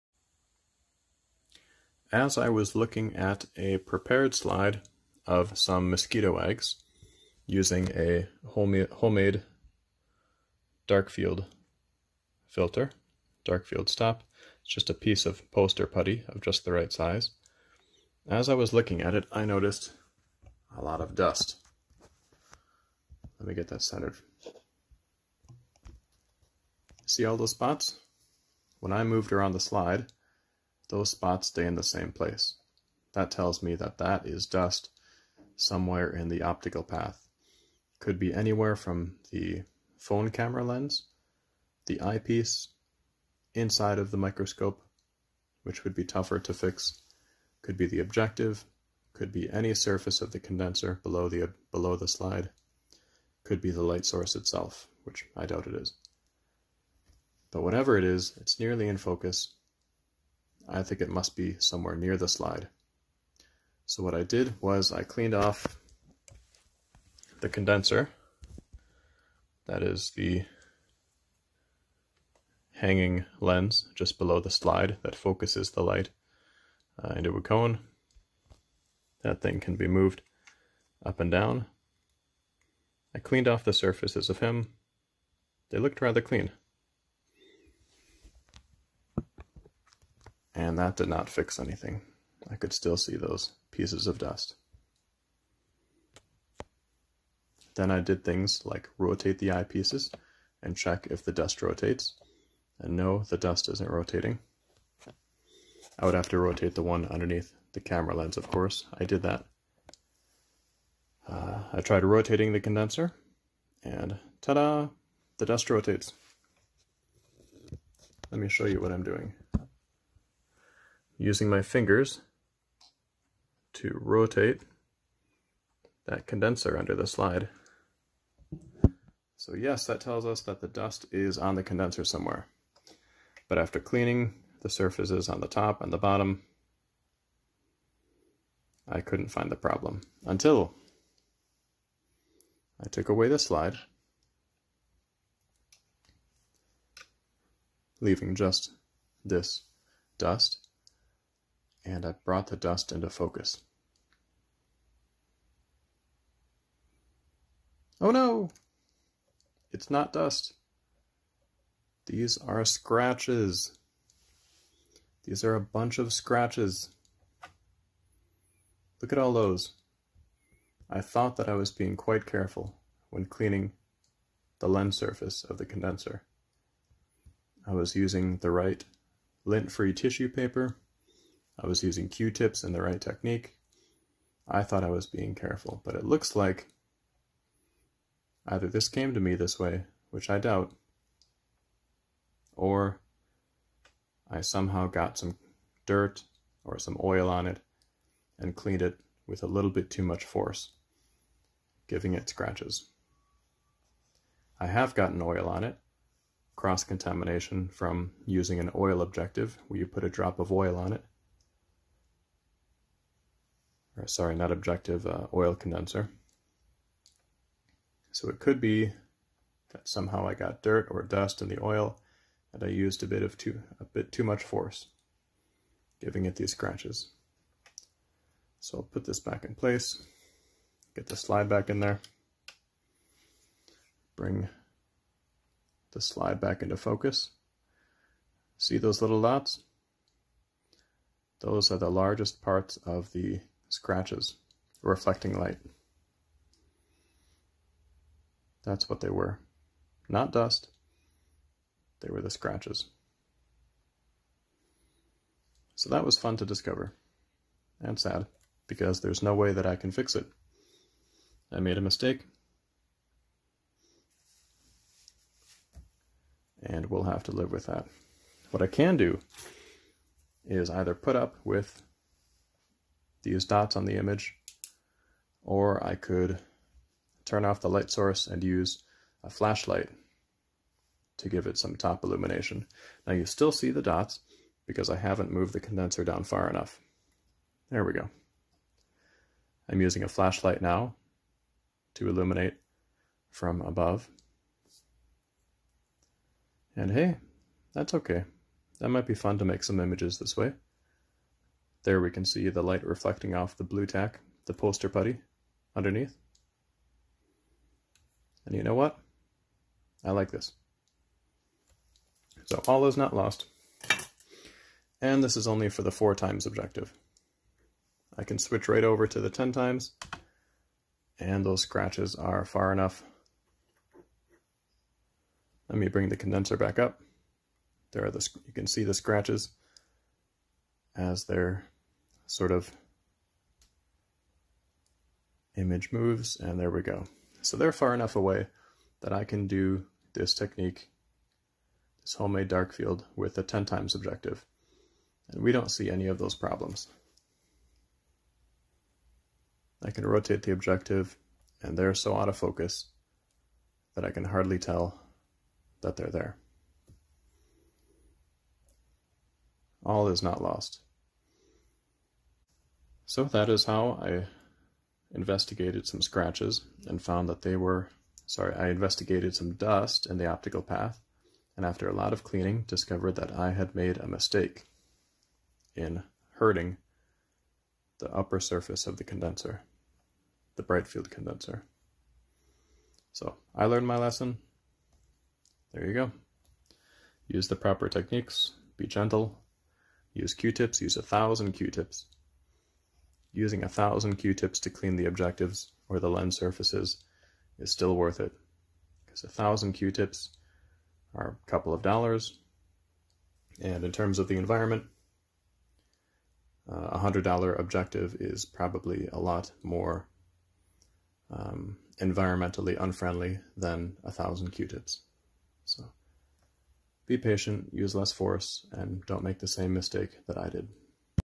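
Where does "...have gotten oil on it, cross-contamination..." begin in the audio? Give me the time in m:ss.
3:24.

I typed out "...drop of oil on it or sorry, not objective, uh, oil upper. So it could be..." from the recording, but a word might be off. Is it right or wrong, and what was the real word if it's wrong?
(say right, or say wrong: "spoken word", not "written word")
wrong: "condenser", not "upper".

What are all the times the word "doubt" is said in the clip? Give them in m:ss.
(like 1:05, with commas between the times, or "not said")
0:55, 3:10.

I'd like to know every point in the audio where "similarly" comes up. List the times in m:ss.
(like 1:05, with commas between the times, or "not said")
not said.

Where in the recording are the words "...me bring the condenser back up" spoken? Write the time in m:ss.
5:25.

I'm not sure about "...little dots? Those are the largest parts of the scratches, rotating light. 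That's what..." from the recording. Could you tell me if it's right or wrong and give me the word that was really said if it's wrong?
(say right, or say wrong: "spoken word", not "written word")
wrong: "reflecting", not "rotating".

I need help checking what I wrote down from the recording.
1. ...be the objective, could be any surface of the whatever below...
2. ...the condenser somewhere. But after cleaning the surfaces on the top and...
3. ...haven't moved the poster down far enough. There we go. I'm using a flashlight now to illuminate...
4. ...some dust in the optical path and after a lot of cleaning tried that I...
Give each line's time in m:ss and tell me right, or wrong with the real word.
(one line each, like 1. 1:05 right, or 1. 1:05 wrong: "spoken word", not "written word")
1. 0:47 wrong: "condenser", not "whatever"
2. 2:11 right
3. 4:44 wrong: "condenser", not "poster"
4. 6:09 wrong: "discovered", not "tried".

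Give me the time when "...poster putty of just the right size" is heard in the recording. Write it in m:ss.
0:15.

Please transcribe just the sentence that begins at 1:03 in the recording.
So what I did was I cleaned off the condenser.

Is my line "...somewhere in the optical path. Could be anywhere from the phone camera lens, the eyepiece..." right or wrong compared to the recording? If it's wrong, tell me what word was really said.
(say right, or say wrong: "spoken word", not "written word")
right.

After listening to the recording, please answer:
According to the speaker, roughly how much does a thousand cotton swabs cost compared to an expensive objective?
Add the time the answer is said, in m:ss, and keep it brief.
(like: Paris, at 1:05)
A couple of dollars, at 6:41.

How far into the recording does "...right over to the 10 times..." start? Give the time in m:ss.
5:18.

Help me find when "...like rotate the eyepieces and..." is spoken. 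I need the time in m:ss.
1:38.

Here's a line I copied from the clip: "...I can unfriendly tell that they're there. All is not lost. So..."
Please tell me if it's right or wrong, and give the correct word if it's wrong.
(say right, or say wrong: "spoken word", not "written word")
wrong: "hardly", not "unfriendly".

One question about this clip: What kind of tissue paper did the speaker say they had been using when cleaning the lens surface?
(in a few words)
Lint-free tissue paper.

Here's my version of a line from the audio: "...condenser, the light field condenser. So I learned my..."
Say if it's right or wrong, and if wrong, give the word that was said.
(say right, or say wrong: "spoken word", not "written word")
wrong: "bright", not "light".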